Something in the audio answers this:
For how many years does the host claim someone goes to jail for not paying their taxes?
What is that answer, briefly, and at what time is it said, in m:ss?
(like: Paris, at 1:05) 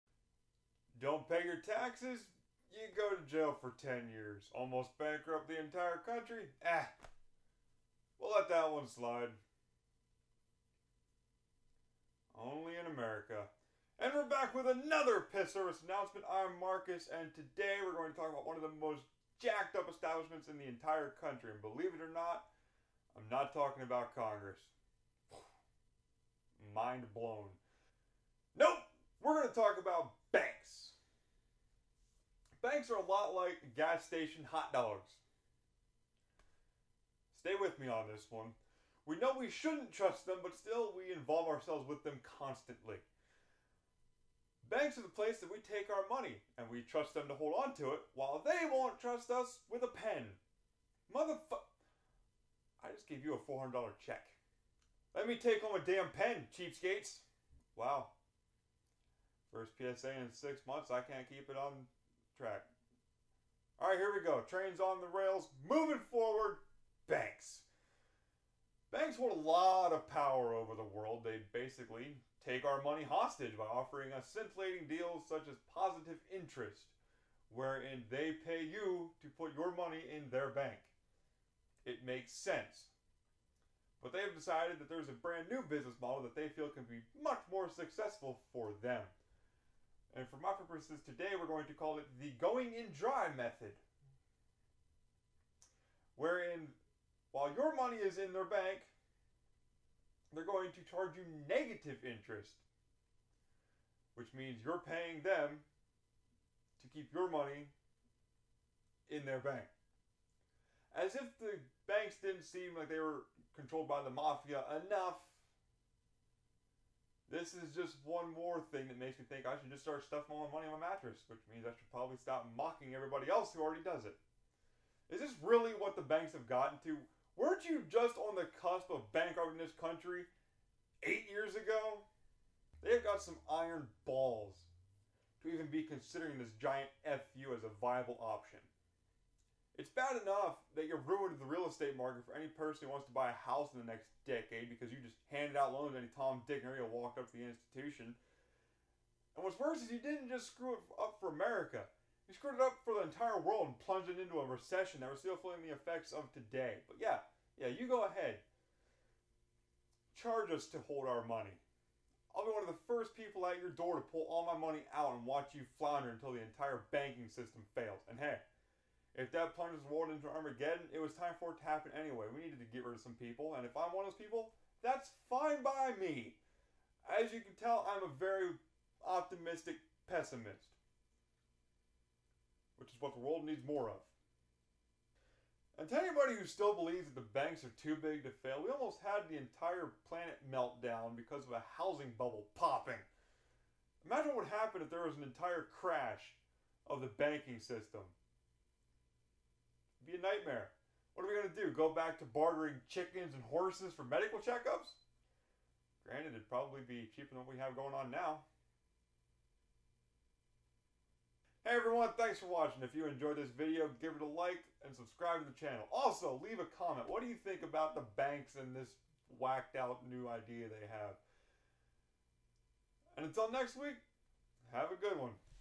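10, at 0:03.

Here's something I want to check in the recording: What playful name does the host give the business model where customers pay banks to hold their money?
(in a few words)
going in dry method.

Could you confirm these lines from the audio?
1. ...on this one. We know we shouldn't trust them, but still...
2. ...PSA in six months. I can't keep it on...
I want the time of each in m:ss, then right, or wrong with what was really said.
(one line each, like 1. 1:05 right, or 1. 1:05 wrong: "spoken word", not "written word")
1. 0:37 right
2. 0:59 right.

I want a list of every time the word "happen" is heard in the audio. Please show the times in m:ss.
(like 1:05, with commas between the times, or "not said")
2:51, 3:14.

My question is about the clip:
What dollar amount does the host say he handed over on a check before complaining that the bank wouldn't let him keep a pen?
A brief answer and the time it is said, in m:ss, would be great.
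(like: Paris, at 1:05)
$400, at 0:53.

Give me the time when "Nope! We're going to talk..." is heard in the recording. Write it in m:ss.
0:28.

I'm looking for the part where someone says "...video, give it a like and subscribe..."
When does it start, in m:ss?
3:33.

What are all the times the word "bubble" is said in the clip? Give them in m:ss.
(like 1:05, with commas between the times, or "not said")
3:12.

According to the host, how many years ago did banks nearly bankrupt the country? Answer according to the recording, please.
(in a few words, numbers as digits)
8.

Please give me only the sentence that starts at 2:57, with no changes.
As you can tell, I'm a very optimistic pessimist, which is what the world needs more of.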